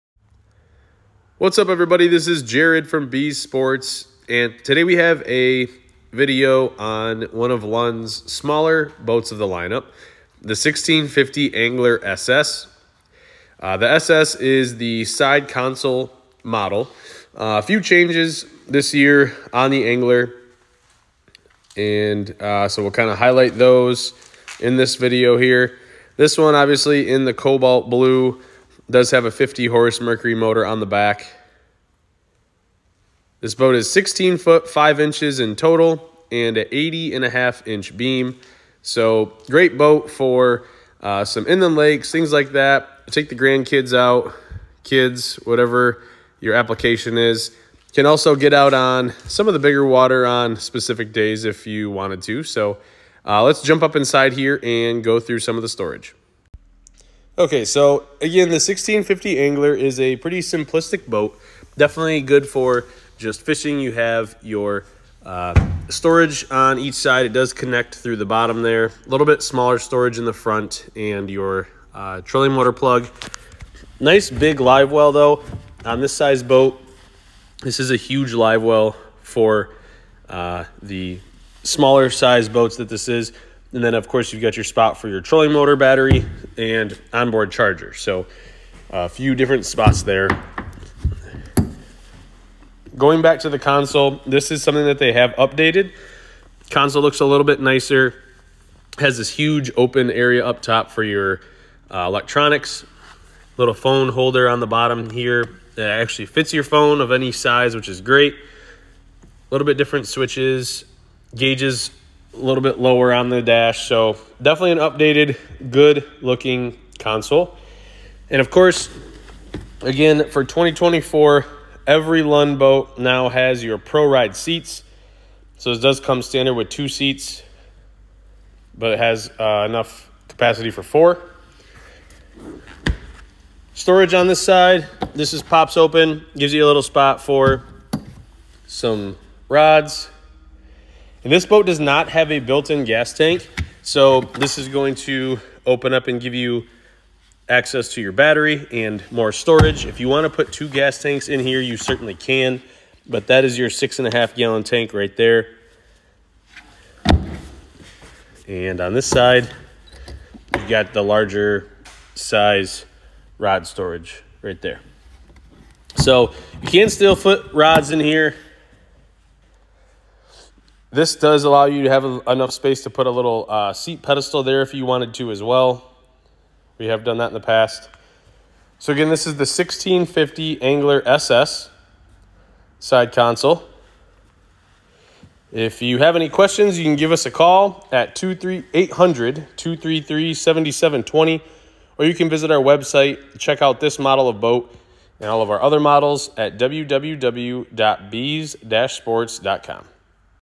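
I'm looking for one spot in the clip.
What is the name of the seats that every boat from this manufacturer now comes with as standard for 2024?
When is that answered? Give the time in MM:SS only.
02:03.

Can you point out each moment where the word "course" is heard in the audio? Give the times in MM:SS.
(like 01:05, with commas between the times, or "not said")
01:24, 01:58.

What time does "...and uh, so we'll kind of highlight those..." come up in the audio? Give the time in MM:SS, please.
00:21.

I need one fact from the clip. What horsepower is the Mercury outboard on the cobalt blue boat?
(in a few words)
50.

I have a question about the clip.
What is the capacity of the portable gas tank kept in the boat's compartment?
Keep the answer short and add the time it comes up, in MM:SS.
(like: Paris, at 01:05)
6.5 gallons, at 02:33.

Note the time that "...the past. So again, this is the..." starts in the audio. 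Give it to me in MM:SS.
02:57.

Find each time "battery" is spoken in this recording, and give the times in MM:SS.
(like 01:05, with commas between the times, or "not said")
01:25, 02:28.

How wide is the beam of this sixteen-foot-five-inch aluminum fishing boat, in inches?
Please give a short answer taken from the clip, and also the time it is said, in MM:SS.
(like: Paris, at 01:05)
80.5 inches, at 00:36.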